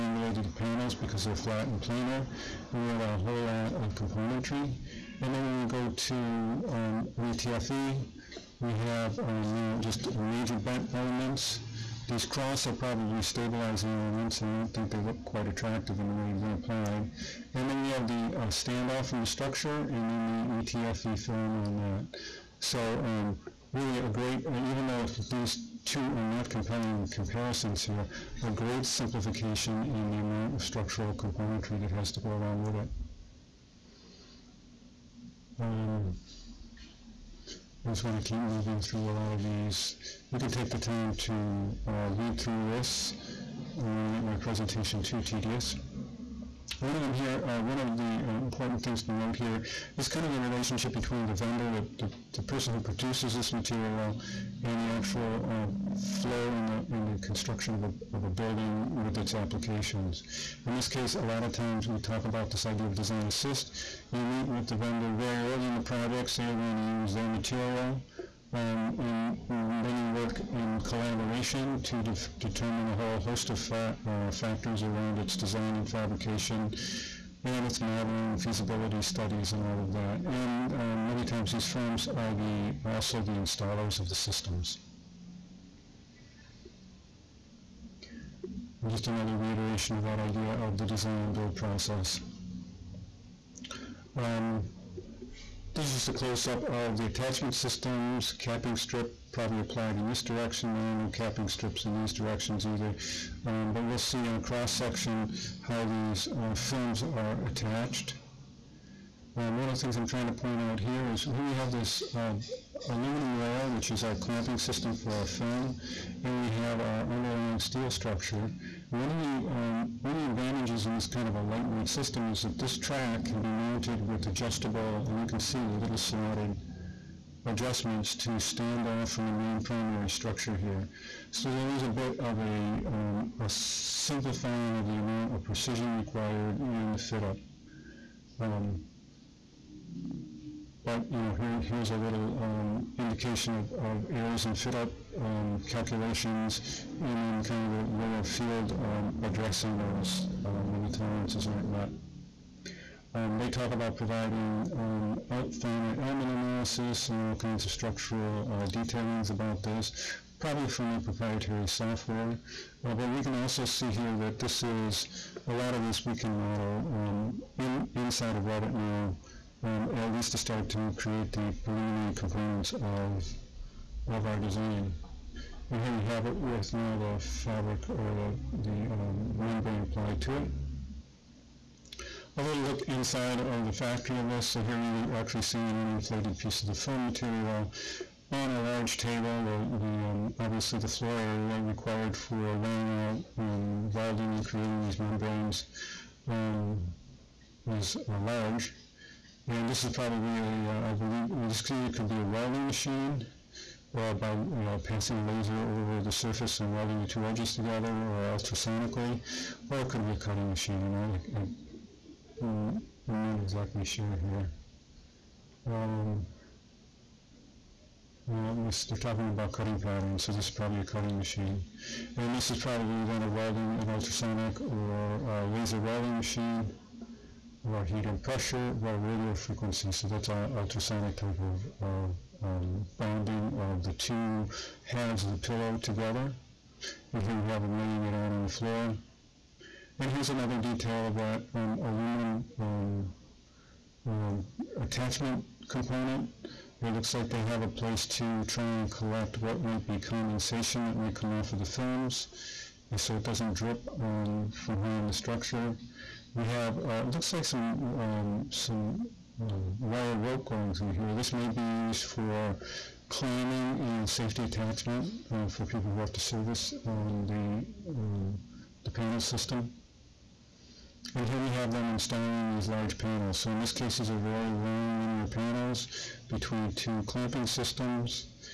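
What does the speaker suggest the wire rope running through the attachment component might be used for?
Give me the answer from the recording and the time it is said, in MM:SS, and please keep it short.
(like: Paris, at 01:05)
climbing and safety attachment, at 04:23.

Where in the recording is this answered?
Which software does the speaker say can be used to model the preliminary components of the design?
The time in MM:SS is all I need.
02:48.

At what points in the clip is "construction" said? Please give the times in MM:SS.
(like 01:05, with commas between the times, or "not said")
00:57.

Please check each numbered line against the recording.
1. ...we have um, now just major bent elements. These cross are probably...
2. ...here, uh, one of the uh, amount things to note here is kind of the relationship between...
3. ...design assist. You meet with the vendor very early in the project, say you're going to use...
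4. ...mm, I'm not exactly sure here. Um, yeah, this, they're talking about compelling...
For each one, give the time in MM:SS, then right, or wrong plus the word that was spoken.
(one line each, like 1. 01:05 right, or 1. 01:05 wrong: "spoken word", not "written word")
1. 00:08 right
2. 00:47 wrong: "important", not "amount"
3. 01:02 right
4. 03:32 wrong: "cutting", not "compelling".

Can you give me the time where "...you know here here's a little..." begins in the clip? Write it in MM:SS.
02:21.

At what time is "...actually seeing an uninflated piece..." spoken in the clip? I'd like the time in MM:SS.
03:05.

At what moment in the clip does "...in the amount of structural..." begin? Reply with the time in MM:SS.
00:29.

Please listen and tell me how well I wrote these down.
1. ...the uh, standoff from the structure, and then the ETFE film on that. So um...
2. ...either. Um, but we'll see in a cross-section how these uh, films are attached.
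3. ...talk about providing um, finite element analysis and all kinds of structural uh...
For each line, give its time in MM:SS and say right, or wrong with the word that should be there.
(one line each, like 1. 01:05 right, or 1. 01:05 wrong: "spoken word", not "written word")
1. 00:18 right
2. 01:42 right
3. 02:33 right.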